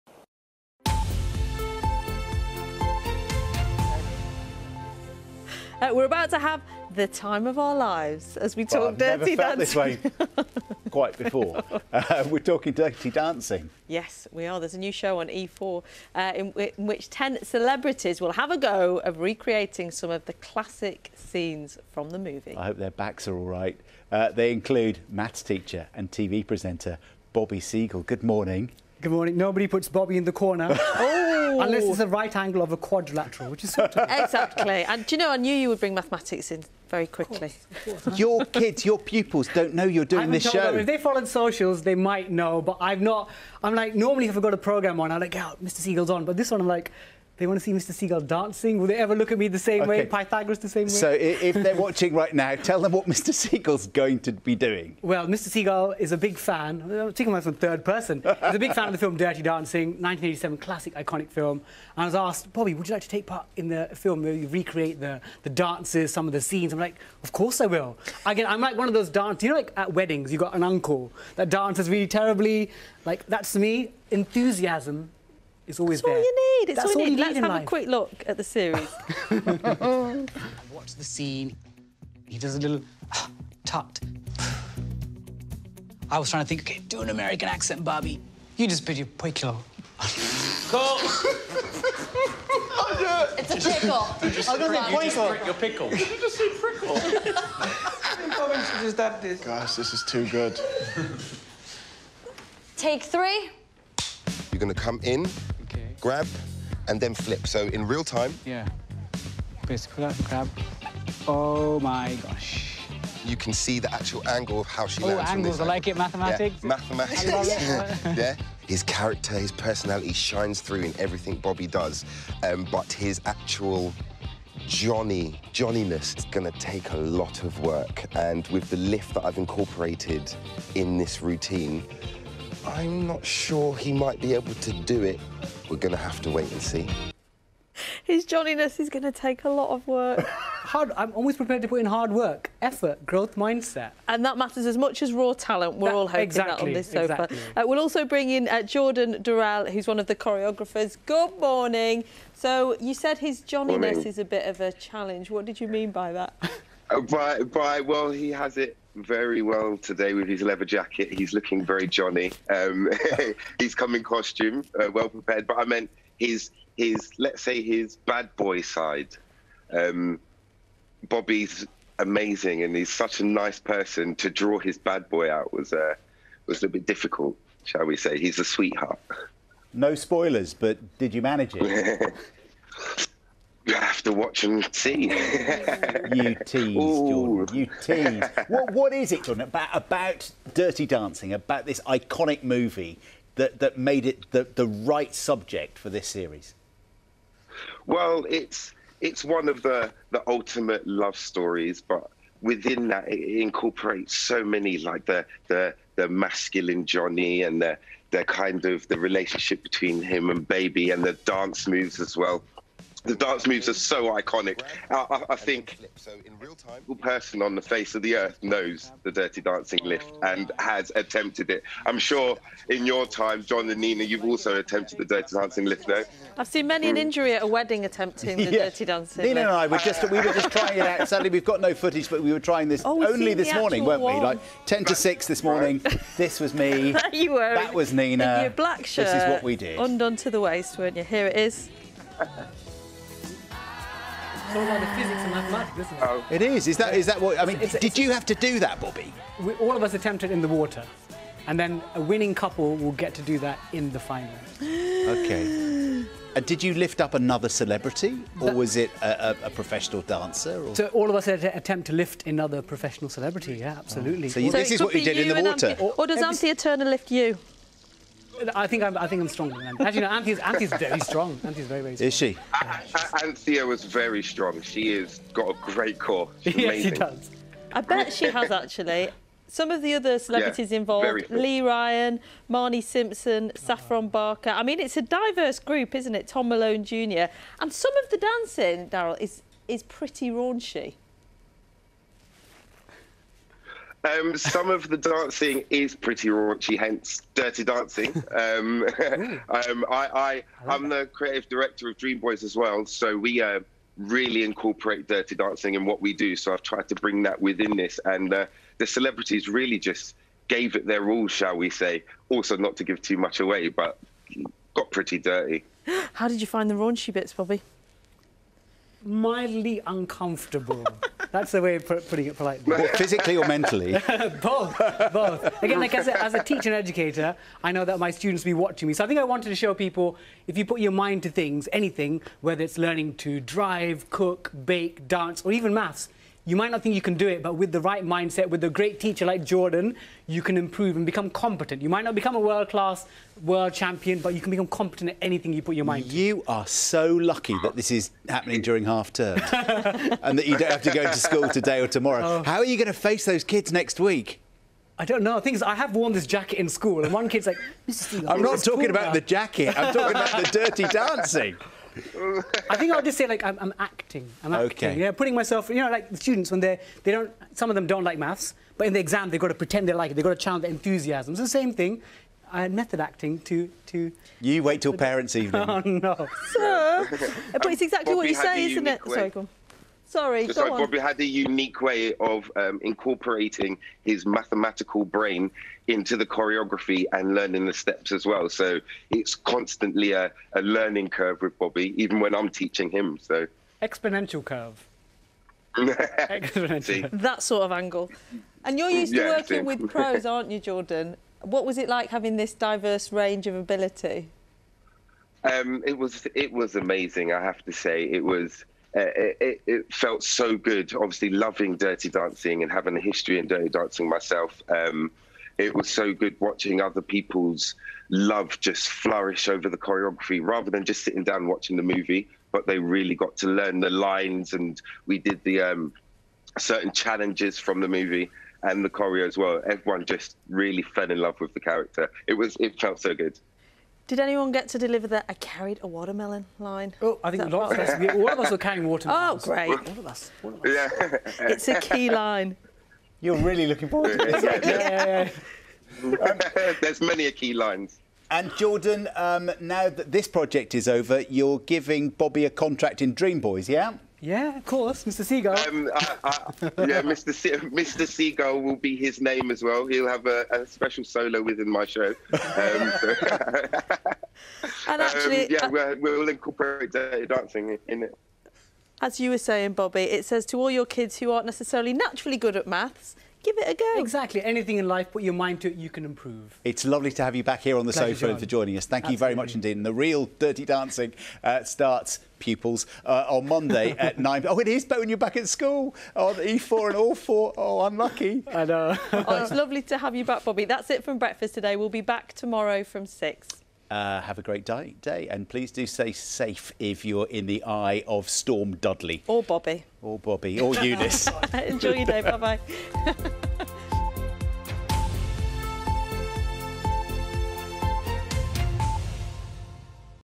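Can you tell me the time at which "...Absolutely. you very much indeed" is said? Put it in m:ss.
7:59.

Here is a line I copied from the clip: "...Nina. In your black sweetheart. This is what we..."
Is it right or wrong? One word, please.
wrong.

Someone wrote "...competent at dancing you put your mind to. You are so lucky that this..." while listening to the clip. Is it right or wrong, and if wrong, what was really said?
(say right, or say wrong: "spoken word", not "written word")
wrong: "anything", not "dancing".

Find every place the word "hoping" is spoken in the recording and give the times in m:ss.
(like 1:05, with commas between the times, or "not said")
2:26.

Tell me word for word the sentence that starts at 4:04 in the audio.
It's about the physics and mathematics, isn't it?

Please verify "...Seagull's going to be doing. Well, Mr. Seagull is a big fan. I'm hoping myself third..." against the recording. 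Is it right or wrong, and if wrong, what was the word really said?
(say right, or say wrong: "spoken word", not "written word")
wrong: "taking", not "hoping".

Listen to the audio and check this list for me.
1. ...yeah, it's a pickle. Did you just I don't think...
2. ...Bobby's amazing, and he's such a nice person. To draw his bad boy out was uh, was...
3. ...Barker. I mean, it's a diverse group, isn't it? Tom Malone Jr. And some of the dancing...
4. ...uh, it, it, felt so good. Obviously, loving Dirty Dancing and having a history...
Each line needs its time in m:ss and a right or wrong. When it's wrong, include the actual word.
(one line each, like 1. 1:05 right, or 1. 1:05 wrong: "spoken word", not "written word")
1. 1:30 right
2. 2:51 right
3. 4:44 right
4. 6:48 right.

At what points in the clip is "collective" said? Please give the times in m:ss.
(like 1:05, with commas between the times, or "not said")
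not said.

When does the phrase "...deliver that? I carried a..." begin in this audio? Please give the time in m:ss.
7:14.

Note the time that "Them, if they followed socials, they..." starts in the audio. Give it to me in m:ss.
0:40.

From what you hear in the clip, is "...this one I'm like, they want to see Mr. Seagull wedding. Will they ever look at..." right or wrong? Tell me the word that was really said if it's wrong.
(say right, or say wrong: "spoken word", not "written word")
wrong: "dancing", not "wedding".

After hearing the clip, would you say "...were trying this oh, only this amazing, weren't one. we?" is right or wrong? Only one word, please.
wrong.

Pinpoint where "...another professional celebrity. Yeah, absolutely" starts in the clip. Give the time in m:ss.
4:22.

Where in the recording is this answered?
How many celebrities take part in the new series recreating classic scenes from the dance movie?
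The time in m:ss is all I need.
0:17.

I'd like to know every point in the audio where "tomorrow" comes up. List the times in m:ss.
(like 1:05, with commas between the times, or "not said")
5:51, 8:12.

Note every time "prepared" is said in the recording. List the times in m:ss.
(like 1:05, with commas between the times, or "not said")
2:21, 2:45.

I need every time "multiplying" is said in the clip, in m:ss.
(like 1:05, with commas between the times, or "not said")
not said.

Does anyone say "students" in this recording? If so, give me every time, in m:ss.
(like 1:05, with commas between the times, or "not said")
5:28, 6:06.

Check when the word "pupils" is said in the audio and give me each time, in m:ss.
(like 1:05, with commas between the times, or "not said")
0:38, 8:02.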